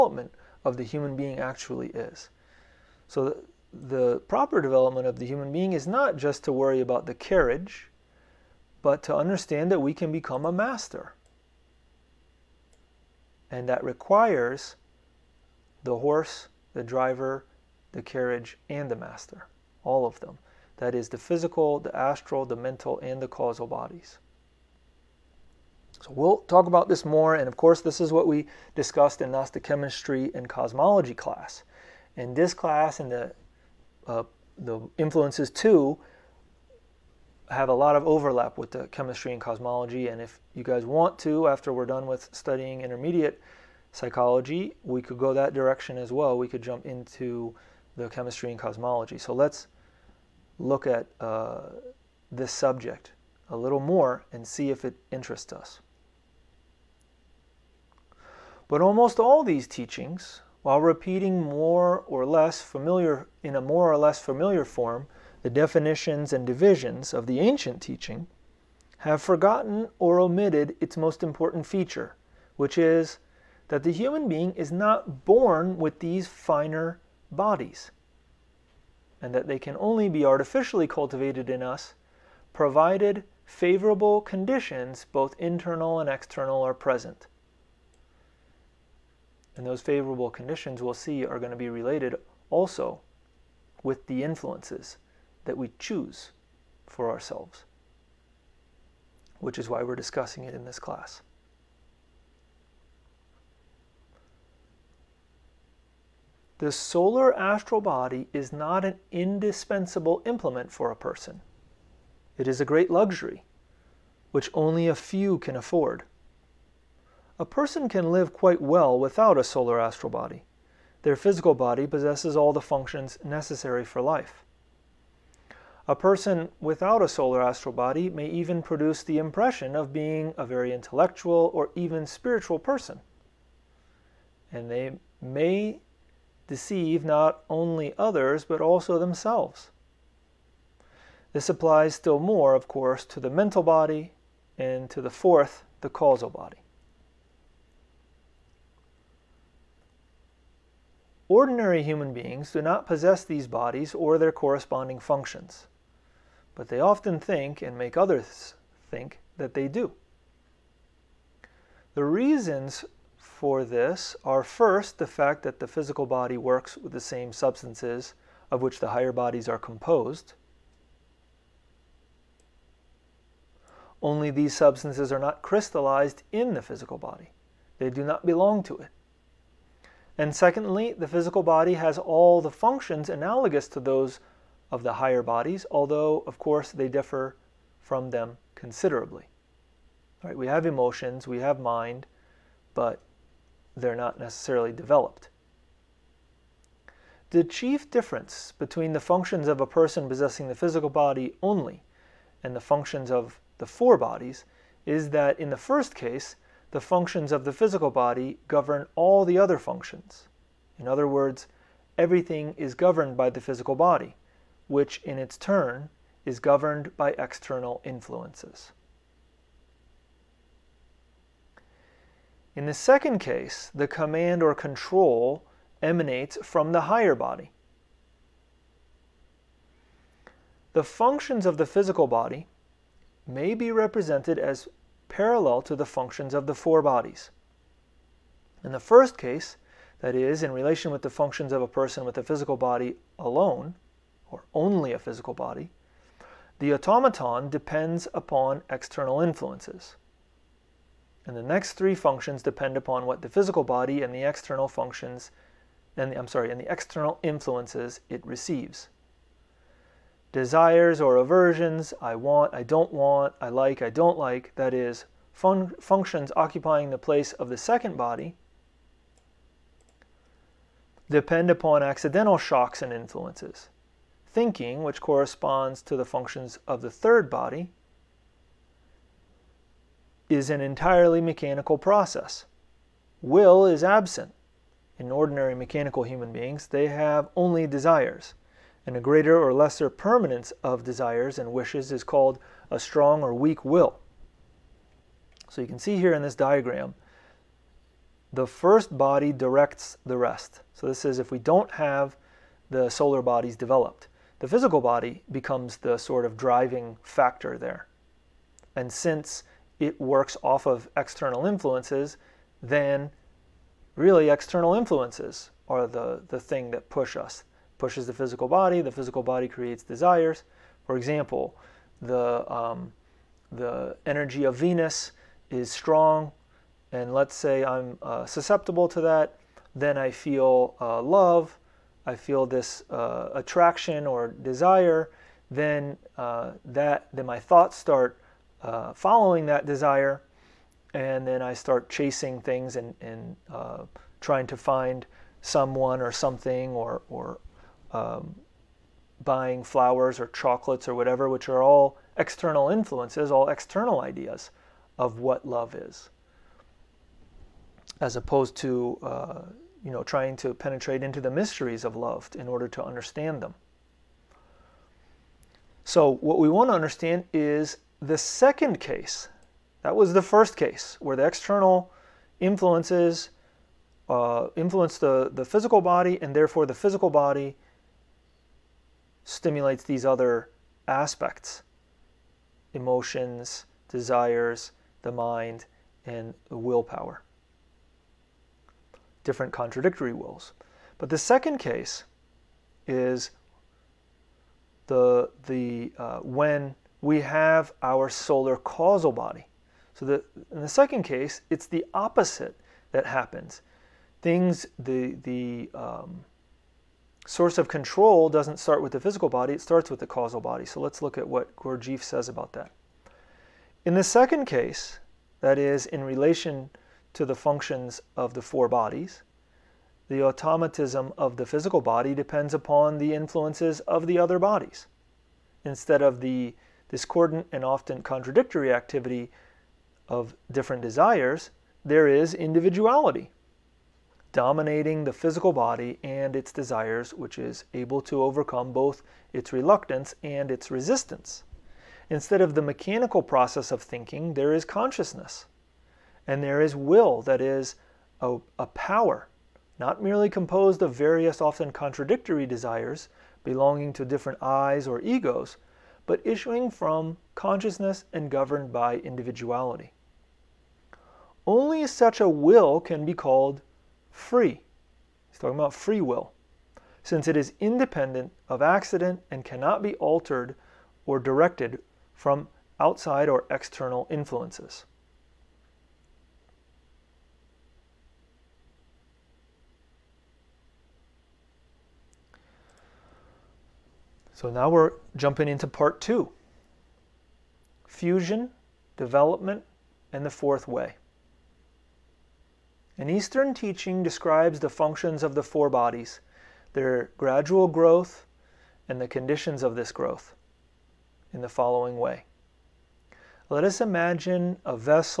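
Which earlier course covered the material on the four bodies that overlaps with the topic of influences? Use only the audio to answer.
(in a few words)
Gnostic chemistry and cosmology.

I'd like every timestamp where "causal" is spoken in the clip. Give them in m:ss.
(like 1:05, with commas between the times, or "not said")
0:23, 2:25, 6:38, 6:50.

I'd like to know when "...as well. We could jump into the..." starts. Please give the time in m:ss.
0:45.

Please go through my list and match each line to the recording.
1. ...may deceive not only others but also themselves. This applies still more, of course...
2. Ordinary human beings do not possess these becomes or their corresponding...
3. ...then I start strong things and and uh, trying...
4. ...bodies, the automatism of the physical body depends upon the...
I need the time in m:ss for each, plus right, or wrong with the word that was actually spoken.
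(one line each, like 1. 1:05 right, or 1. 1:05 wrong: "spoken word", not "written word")
1. 2:15 right
2. 2:31 wrong: "bodies", not "becomes"
3. 5:41 wrong: "chasing", not "strong"
4. 6:58 right.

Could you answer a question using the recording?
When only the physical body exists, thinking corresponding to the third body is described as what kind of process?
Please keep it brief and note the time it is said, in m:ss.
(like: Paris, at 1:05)
Entirely mechanical, at 4:40.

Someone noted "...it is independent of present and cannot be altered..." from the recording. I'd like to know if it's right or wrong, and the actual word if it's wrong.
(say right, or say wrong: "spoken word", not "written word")
wrong: "accident", not "present".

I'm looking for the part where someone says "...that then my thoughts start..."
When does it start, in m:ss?
5:36.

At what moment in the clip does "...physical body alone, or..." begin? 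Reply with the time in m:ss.
4:02.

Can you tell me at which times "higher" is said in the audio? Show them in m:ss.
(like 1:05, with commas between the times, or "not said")
2:48, 3:04, 3:46.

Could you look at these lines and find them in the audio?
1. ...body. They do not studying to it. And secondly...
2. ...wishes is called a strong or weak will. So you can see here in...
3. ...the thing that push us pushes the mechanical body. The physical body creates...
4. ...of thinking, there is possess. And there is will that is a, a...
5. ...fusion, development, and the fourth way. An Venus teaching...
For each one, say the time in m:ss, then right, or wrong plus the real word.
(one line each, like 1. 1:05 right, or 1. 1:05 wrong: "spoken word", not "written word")
1. 2:56 wrong: "belong", not "studying"
2. 4:51 right
3. 5:16 wrong: "physical", not "mechanical"
4. 7:23 wrong: "consciousness", not "possess"
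5. 8:07 wrong: "Eastern", not "Venus".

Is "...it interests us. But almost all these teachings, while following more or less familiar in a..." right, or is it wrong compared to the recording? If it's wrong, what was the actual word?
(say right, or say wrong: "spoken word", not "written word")
wrong: "repeating", not "following".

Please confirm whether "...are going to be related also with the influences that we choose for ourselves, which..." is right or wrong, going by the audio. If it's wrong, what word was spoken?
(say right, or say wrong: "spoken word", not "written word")
right.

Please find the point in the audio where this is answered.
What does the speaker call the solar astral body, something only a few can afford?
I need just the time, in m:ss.
1:52.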